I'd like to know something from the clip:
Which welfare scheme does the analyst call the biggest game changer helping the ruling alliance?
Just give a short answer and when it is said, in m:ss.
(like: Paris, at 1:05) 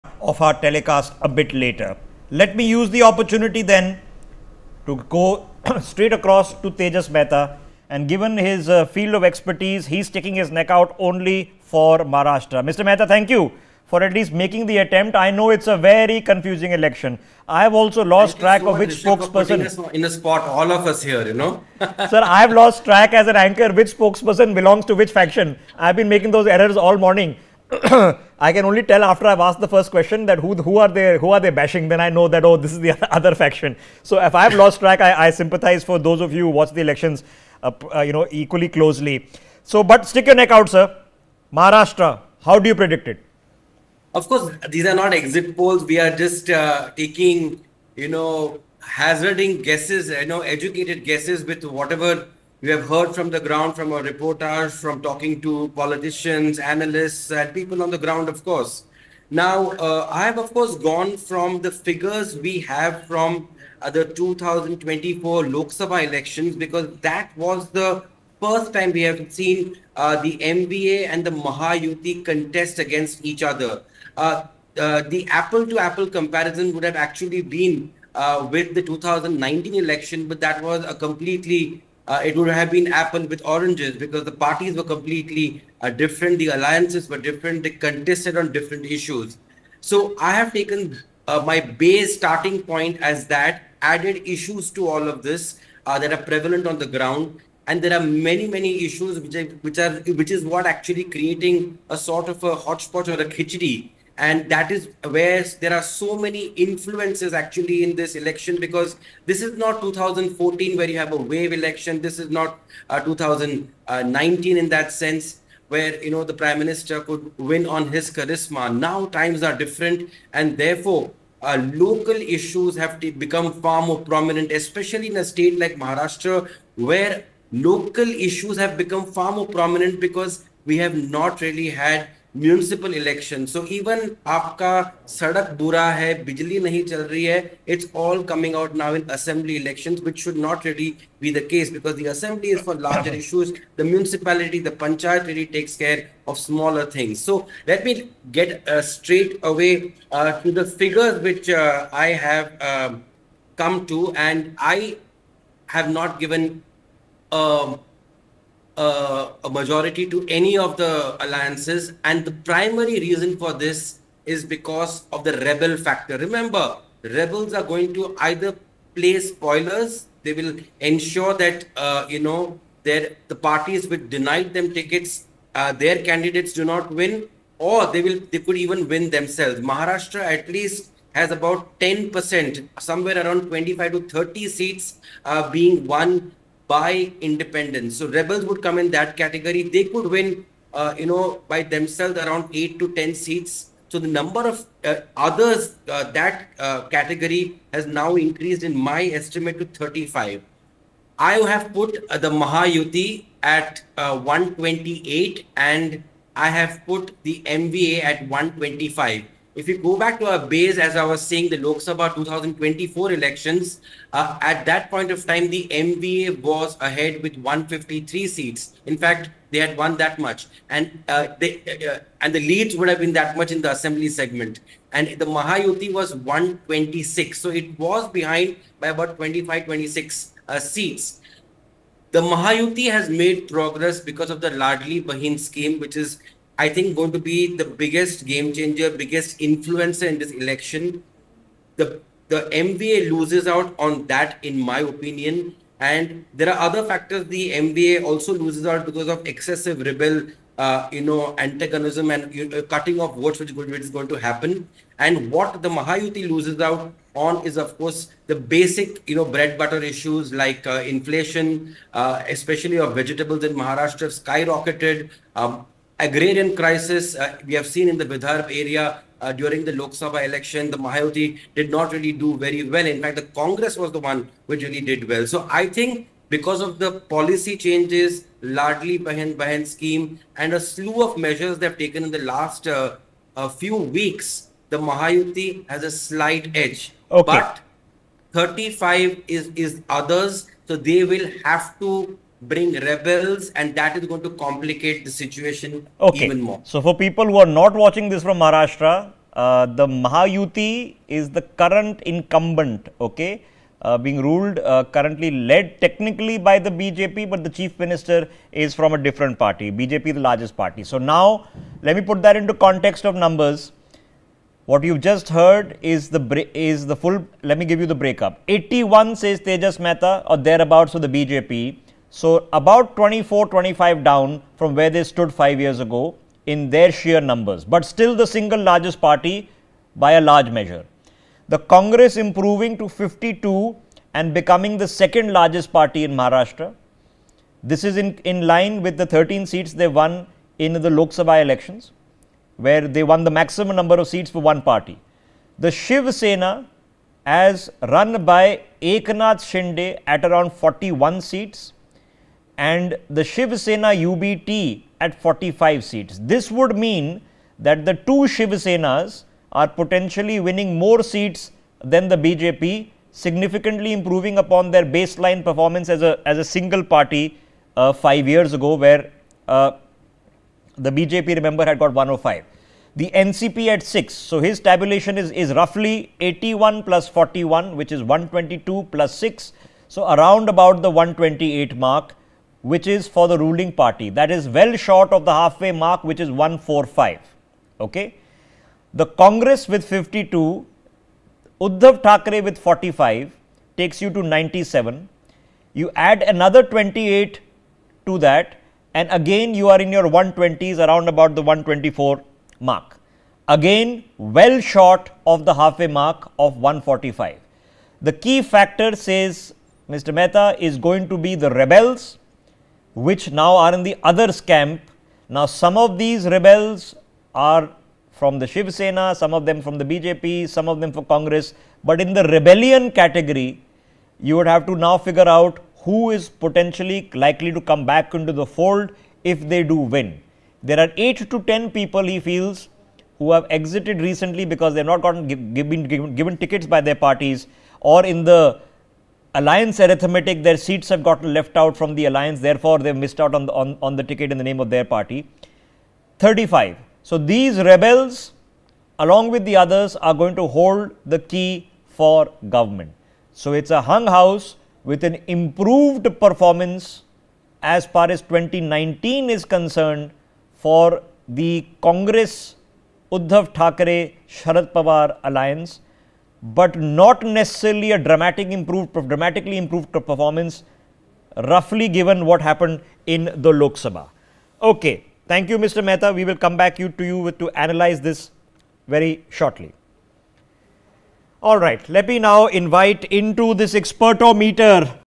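Ladki Bahin scheme, at 3:54.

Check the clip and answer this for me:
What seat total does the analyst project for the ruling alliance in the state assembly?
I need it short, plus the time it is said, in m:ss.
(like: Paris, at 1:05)
128, at 3:22.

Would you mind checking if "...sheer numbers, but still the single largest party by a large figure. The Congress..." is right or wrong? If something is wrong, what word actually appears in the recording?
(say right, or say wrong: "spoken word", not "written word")
wrong: "measure", not "figure".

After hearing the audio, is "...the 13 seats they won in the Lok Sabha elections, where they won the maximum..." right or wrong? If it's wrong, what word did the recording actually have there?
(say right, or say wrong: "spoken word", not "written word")
right.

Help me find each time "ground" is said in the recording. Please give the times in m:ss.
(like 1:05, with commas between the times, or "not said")
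0:53, 0:57, 1:36.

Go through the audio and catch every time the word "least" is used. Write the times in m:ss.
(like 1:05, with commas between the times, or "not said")
0:14, 3:00.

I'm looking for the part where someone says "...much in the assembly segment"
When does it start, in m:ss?
3:43.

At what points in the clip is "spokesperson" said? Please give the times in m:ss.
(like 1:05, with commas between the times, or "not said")
0:18, 0:23.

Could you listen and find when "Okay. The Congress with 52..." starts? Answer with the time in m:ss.
6:27.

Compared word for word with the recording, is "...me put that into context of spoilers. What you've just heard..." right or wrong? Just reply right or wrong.
wrong.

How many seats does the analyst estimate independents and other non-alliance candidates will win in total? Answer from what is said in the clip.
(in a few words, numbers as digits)
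35.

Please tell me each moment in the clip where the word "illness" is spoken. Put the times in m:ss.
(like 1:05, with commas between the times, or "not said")
not said.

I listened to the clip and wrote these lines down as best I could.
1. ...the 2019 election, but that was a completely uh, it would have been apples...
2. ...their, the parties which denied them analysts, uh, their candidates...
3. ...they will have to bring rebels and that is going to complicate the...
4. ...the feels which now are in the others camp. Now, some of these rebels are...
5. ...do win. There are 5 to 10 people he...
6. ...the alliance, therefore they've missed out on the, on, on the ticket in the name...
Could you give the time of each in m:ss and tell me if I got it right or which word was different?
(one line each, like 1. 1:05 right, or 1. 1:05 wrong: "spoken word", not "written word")
1. 1:18 right
2. 2:52 wrong: "tickets", not "analysts"
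3. 4:50 right
4. 6:51 wrong: "rebels", not "feels"
5. 7:09 wrong: "8", not "5"
6. 7:21 right.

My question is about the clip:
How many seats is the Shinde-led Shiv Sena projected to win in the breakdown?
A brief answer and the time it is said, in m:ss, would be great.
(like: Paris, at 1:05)
41, at 5:48.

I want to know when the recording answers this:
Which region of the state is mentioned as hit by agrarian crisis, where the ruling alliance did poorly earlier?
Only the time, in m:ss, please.
4:28.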